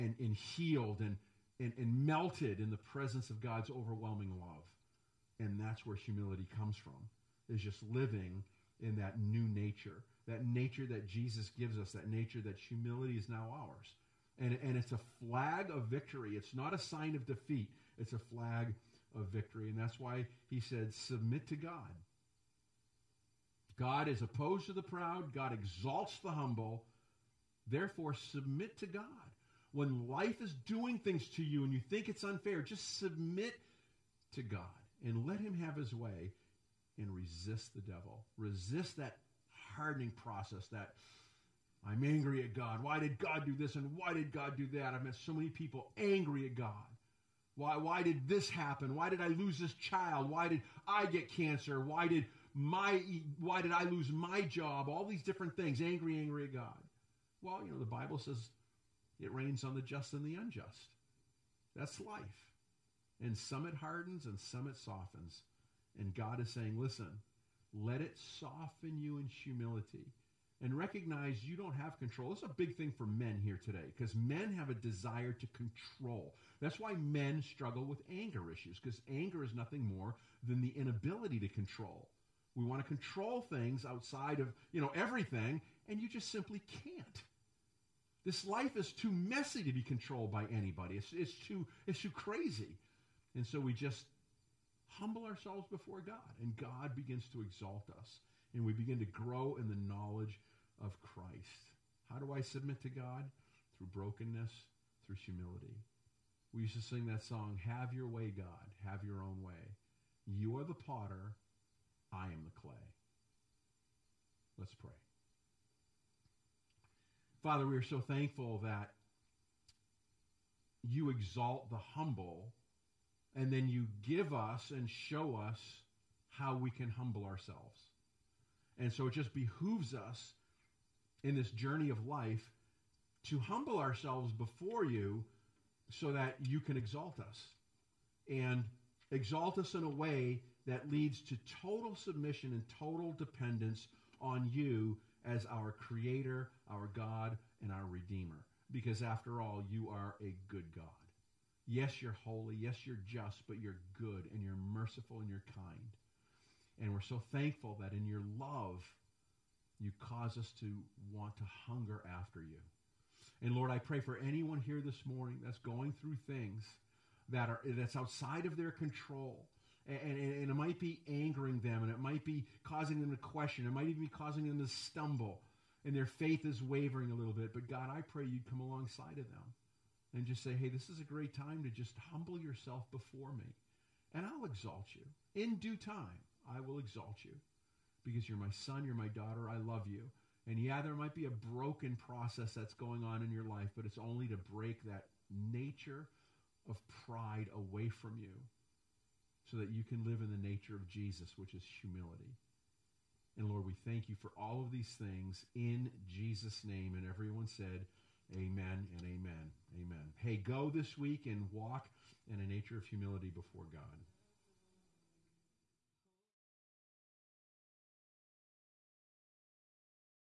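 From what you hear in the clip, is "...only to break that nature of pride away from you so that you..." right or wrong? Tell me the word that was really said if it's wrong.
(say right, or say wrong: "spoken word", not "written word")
right.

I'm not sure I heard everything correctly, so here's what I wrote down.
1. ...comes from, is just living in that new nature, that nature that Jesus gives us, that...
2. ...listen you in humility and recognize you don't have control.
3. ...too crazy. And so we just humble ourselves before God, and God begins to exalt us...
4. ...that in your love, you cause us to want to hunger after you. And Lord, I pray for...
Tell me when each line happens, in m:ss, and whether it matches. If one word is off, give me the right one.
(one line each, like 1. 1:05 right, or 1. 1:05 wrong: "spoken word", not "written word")
1. 0:06 right
2. 1:08 wrong: "soften", not "listen"
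3. 1:32 right
4. 2:37 right.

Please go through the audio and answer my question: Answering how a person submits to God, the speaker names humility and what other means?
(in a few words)
brokenness.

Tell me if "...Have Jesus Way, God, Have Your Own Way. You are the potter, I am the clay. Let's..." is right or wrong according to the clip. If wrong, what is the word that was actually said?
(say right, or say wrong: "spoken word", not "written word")
wrong: "Your", not "Jesus".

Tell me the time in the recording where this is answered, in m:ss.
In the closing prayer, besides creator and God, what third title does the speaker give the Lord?
2:27.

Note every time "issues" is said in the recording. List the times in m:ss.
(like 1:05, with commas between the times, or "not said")
1:18.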